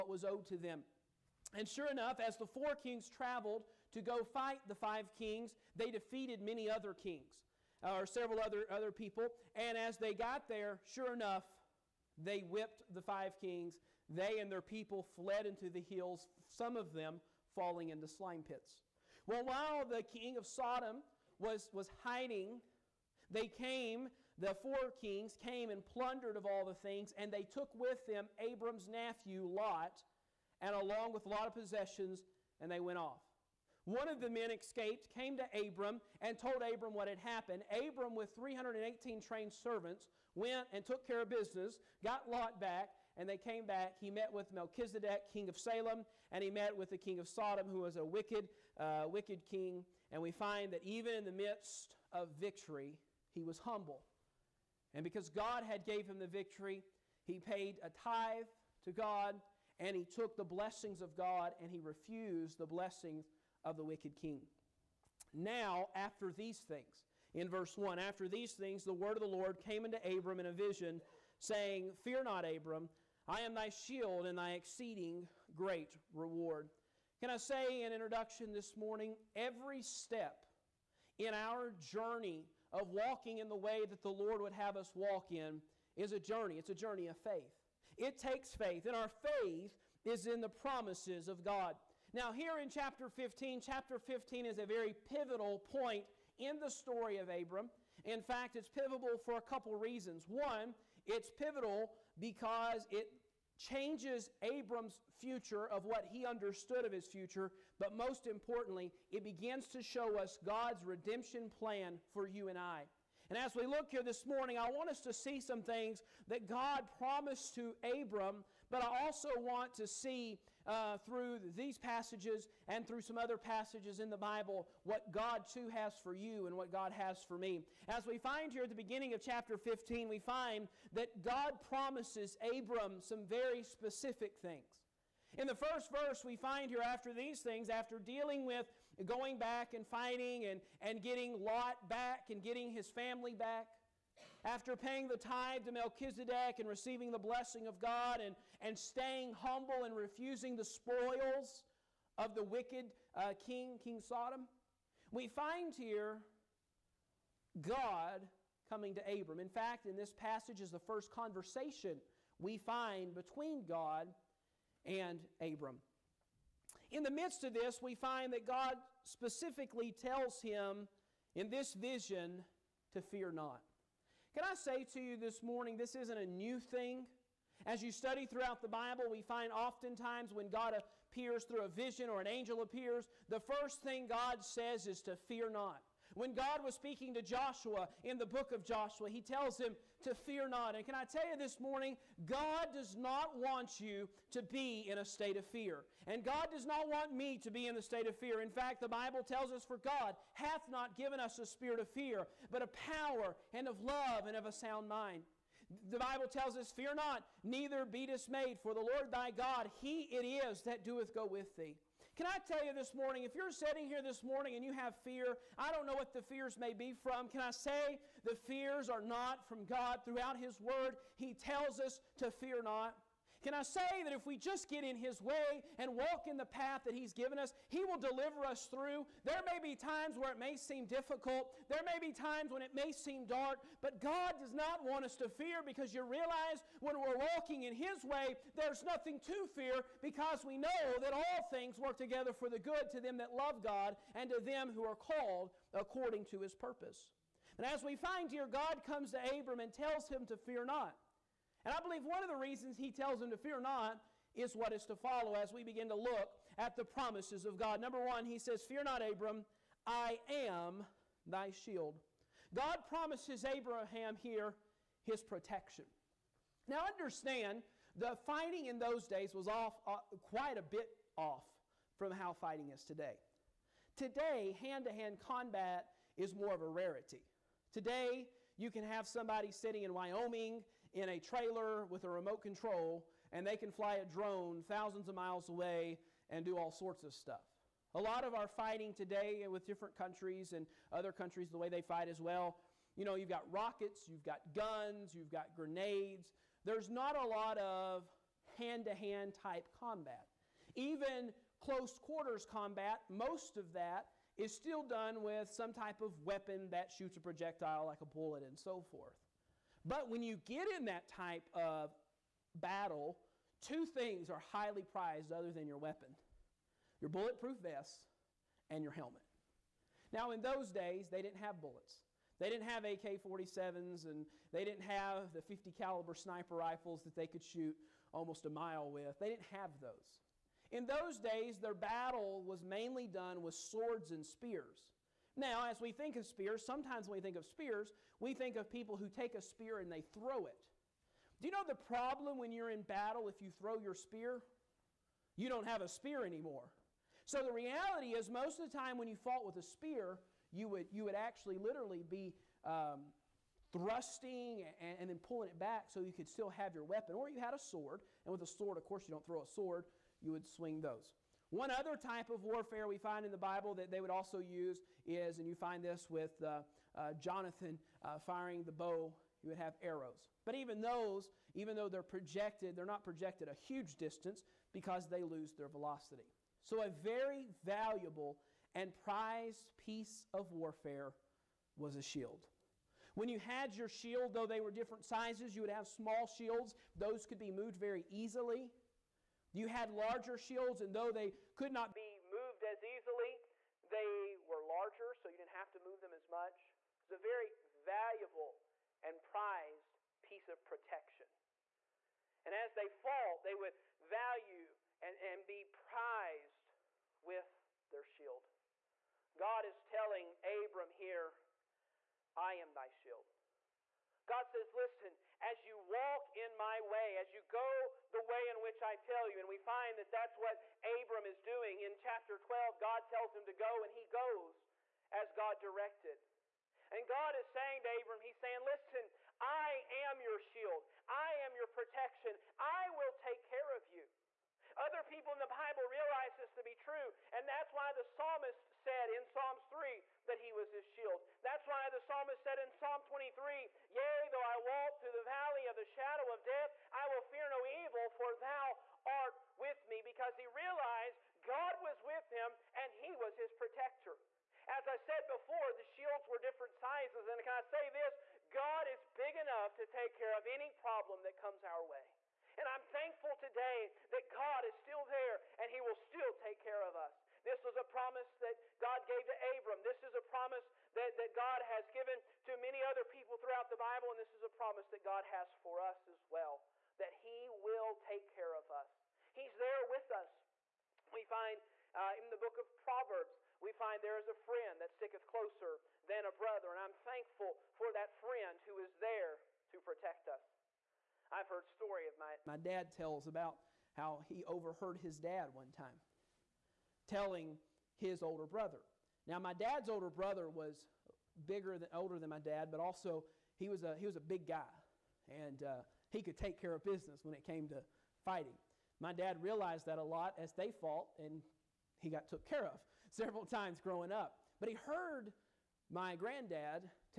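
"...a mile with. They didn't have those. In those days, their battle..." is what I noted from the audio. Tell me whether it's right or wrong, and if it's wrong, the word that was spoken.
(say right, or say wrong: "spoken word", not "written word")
right.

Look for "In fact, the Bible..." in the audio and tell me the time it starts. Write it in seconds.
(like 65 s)
198 s.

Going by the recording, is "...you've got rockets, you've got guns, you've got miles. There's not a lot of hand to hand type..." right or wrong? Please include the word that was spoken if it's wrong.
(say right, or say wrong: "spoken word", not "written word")
wrong: "grenades", not "miles".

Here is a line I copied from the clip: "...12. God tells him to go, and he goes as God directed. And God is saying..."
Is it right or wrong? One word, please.
right.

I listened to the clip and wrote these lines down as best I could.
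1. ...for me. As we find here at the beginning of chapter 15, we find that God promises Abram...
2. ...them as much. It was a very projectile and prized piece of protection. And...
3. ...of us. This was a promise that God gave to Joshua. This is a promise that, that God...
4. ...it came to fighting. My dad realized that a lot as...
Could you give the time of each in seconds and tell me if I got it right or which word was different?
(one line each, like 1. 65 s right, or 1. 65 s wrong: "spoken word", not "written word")
1. 127 s right
2. 396 s wrong: "valuable", not "projectile"
3. 466 s wrong: "Abram", not "Joshua"
4. 507 s right.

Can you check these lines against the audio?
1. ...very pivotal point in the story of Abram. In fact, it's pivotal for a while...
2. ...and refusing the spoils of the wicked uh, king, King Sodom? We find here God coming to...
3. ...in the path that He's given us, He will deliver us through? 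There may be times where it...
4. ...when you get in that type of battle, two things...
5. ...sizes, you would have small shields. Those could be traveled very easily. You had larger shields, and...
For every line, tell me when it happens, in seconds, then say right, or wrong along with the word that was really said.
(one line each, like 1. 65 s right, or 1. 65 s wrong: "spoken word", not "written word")
1. 94 s wrong: "couple", not "while"
2. 149 s right
3. 226 s right
4. 310 s right
5. 385 s wrong: "moved", not "traveled".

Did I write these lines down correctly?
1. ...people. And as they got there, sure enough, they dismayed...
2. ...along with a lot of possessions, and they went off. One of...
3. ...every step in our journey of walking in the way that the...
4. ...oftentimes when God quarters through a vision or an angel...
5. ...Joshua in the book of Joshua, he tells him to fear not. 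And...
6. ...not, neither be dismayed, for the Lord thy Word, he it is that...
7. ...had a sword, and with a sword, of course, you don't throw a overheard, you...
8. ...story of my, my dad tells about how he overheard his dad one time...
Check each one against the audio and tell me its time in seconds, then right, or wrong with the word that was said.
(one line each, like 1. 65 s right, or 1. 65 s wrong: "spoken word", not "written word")
1. 8 s wrong: "whipped", not "dismayed"
2. 30 s right
3. 79 s right
4. 179 s wrong: "appears", not "quarters"
5. 187 s right
6. 206 s wrong: "God", not "Word"
7. 357 s wrong: "sword", not "overheard"
8. 491 s right.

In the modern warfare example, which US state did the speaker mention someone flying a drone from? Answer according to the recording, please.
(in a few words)
Wyoming.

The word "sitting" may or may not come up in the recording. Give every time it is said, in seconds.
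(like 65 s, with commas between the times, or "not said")
213 s, 279 s.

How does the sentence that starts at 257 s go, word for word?
Number one, he says, Fear not, Abram, I am thy shield.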